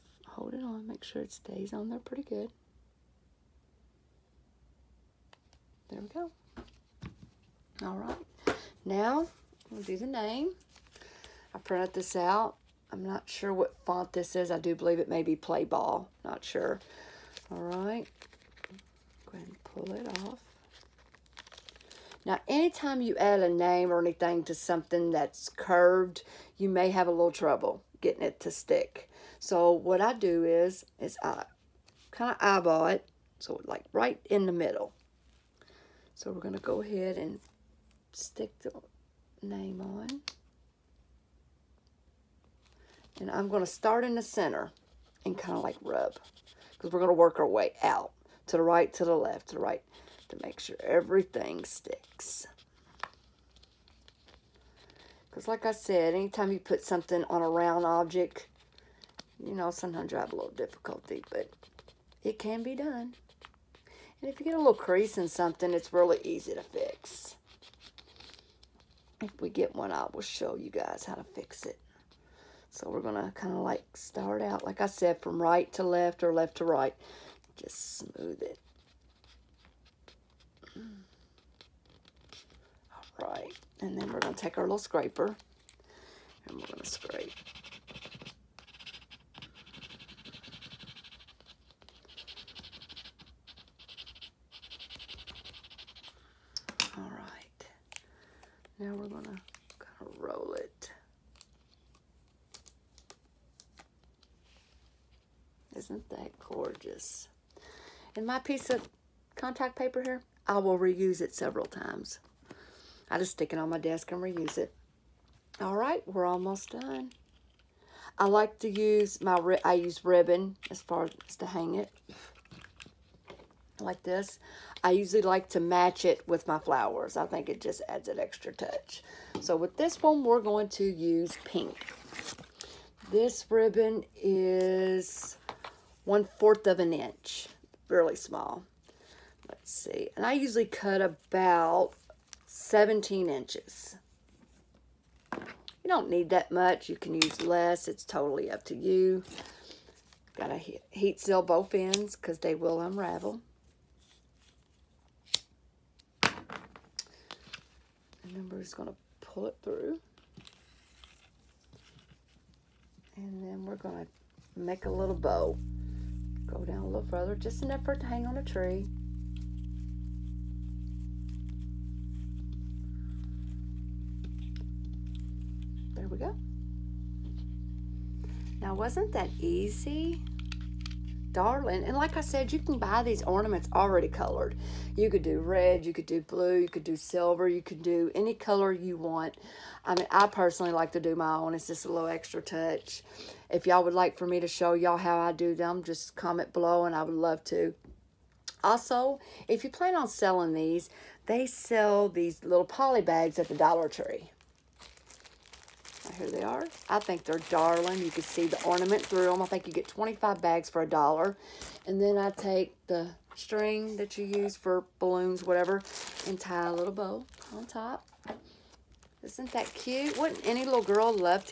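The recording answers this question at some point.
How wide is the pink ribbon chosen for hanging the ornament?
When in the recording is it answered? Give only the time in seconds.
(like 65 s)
136 s.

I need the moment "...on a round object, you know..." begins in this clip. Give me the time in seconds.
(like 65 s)
57 s.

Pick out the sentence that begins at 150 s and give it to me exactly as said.
Got to heat seal both ends because they will unravel.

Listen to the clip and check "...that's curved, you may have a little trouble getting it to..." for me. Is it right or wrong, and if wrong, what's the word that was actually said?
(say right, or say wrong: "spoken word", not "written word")
right.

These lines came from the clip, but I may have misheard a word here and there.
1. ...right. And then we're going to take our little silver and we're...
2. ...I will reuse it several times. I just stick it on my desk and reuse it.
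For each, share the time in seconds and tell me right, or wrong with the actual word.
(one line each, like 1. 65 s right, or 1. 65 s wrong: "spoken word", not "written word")
1. 83 s wrong: "scraper", not "silver"
2. 110 s right.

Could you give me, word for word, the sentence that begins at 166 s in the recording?
Go down a little further, just enough for it to hang on a tree.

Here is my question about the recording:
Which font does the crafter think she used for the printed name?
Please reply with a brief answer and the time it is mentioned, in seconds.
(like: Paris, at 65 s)
Play Ball, at 15 s.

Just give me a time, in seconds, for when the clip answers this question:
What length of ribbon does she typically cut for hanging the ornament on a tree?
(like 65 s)
142 s.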